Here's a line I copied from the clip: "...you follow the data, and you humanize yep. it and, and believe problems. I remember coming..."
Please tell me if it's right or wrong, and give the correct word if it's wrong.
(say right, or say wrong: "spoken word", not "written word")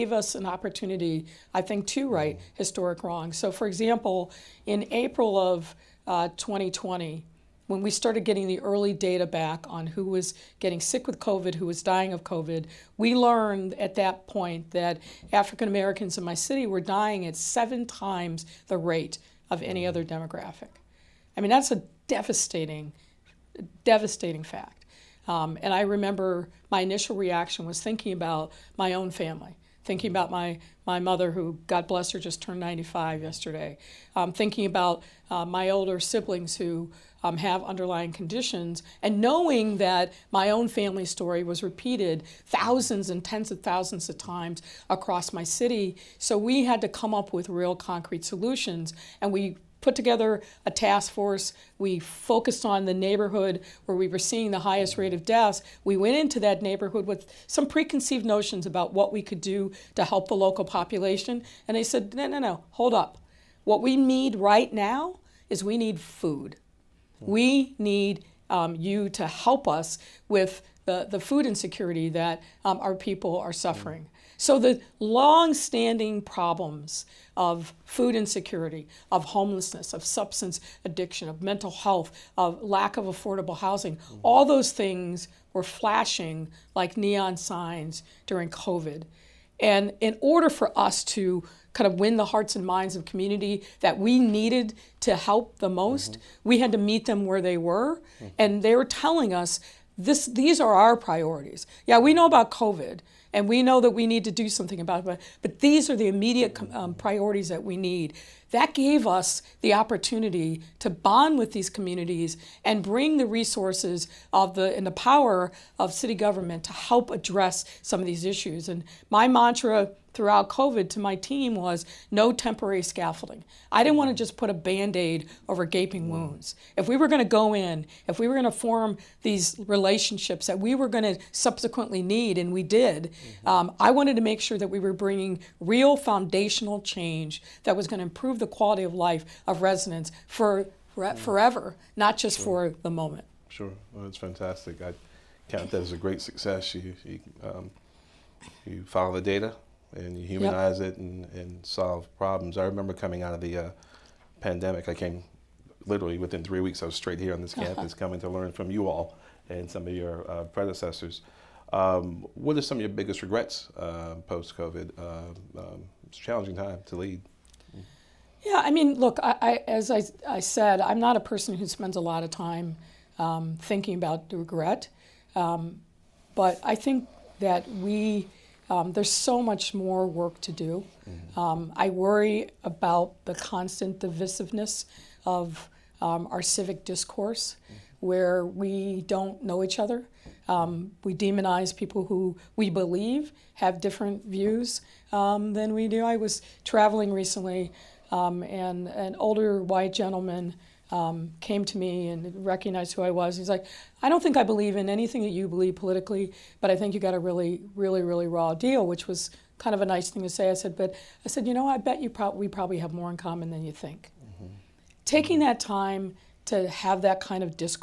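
wrong: "solve", not "believe".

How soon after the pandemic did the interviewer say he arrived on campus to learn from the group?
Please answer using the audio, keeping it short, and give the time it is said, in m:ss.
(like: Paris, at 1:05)
Three weeks, at 2:36.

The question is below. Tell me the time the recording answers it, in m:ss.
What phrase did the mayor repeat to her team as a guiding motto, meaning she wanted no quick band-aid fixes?
2:02.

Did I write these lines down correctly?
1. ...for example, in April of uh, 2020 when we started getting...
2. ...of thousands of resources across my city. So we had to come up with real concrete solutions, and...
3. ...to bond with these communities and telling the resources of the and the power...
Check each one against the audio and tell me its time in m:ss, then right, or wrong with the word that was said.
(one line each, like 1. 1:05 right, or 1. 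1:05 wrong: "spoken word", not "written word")
1. 0:03 right
2. 0:43 wrong: "times", not "resources"
3. 1:50 wrong: "bring", not "telling".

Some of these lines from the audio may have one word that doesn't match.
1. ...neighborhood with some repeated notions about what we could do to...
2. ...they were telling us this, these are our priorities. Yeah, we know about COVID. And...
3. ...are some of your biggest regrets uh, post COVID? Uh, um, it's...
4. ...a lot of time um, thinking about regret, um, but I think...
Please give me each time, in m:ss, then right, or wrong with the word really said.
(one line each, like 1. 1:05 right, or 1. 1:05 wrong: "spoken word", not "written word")
1. 0:56 wrong: "preconceived", not "repeated"
2. 1:38 right
3. 2:42 right
4. 2:51 right.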